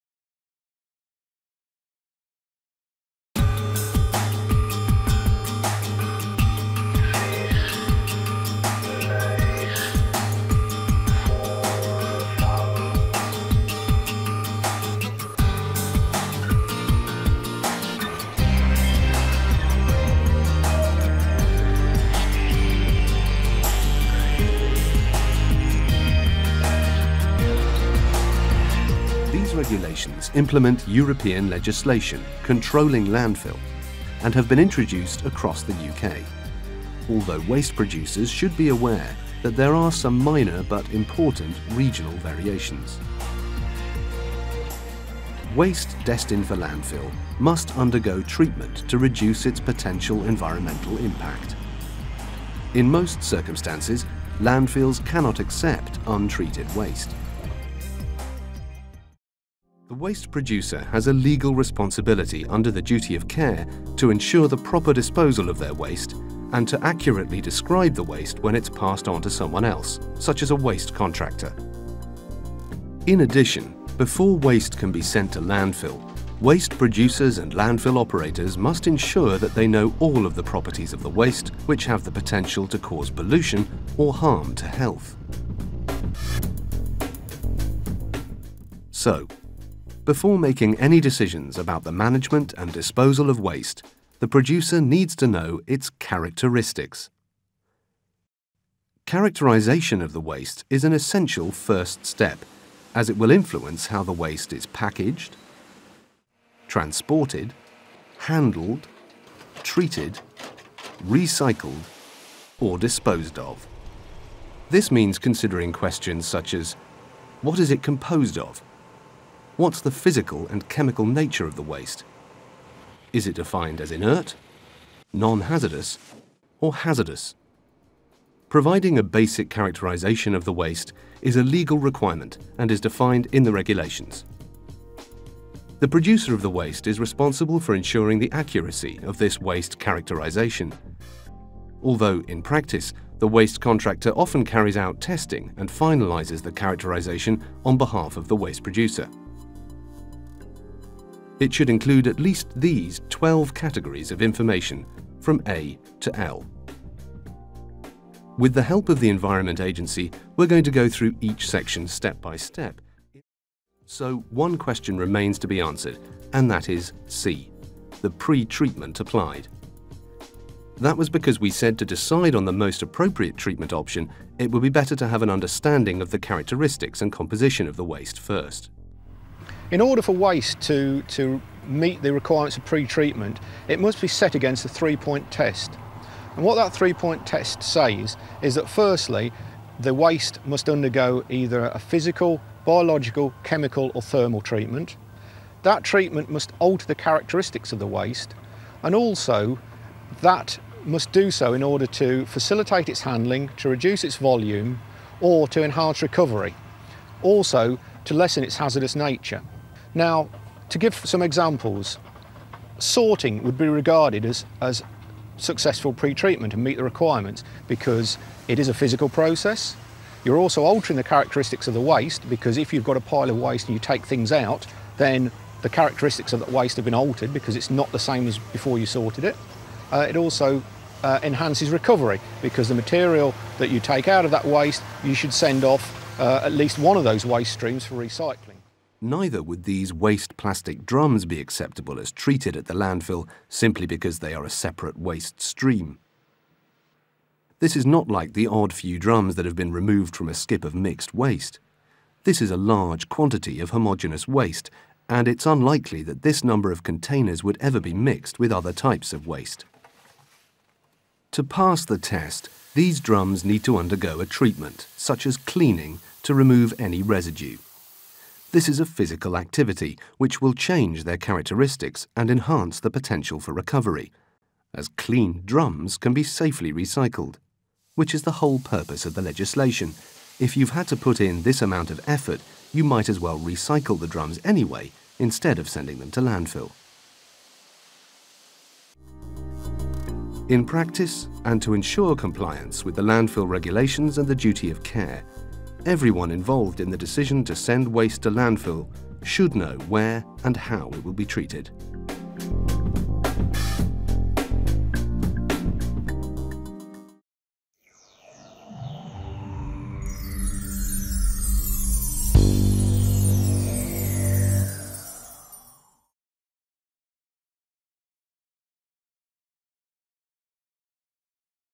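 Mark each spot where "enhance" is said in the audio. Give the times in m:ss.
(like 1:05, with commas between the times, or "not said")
3:25, 3:51, 4:32.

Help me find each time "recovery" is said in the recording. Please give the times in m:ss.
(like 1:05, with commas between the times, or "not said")
3:26, 3:51, 4:33.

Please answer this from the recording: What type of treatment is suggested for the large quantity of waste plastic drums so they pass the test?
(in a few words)
cleaning.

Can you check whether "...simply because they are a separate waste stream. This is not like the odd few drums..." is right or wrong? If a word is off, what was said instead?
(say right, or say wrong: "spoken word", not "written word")
right.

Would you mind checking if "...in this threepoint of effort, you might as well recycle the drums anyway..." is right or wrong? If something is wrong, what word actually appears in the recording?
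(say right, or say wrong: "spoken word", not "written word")
wrong: "amount", not "threepoint".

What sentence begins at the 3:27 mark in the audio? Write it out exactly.
Also to lessen its hazardous nature.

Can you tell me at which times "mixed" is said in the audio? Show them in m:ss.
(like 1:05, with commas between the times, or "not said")
4:10, 4:17.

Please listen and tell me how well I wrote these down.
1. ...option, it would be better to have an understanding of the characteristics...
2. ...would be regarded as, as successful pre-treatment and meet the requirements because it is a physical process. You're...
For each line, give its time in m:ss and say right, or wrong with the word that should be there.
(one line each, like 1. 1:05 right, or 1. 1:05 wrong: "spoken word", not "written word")
1. 2:53 right
2. 3:33 right.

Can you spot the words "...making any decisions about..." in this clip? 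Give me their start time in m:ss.
1:30.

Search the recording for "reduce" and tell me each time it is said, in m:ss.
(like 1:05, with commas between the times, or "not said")
0:48, 3:23.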